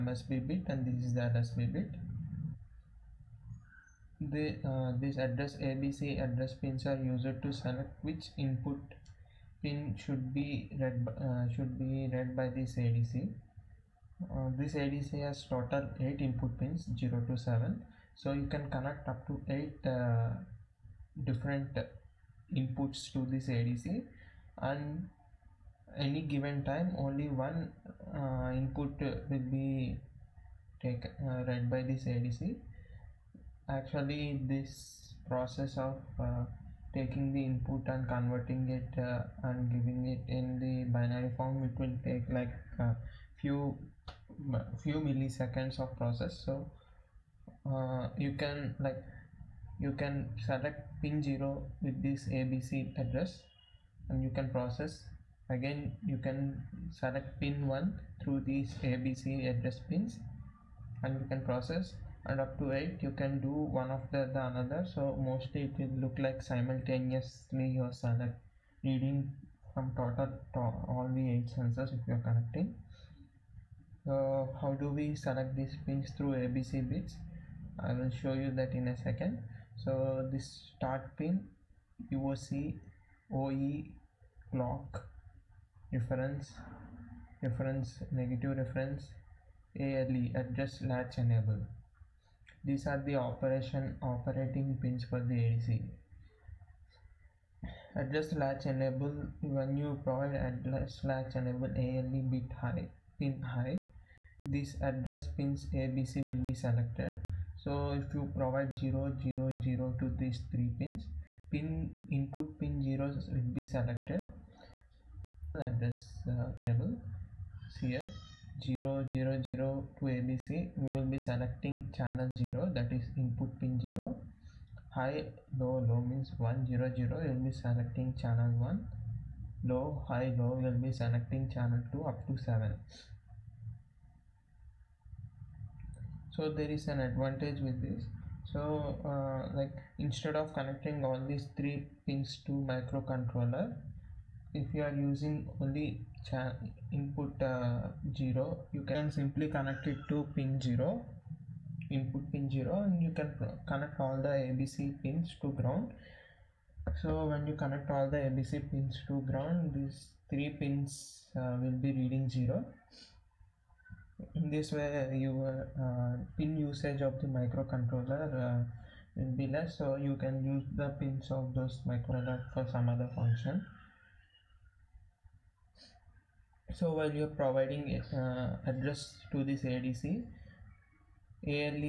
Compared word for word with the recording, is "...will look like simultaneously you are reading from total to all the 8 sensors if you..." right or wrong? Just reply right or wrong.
right.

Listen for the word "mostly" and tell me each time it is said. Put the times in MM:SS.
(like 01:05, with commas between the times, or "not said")
01:05.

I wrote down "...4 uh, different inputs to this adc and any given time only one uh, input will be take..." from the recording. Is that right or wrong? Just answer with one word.
wrong.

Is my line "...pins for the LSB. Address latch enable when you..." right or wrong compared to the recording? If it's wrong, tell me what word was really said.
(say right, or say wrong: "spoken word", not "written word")
wrong: "ADC", not "LSB".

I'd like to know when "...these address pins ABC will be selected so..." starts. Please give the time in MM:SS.
01:44.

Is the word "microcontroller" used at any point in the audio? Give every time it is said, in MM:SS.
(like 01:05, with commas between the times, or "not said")
02:22, 02:47, 02:51.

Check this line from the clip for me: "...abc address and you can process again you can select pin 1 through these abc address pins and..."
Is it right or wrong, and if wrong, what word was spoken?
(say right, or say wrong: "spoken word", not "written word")
right.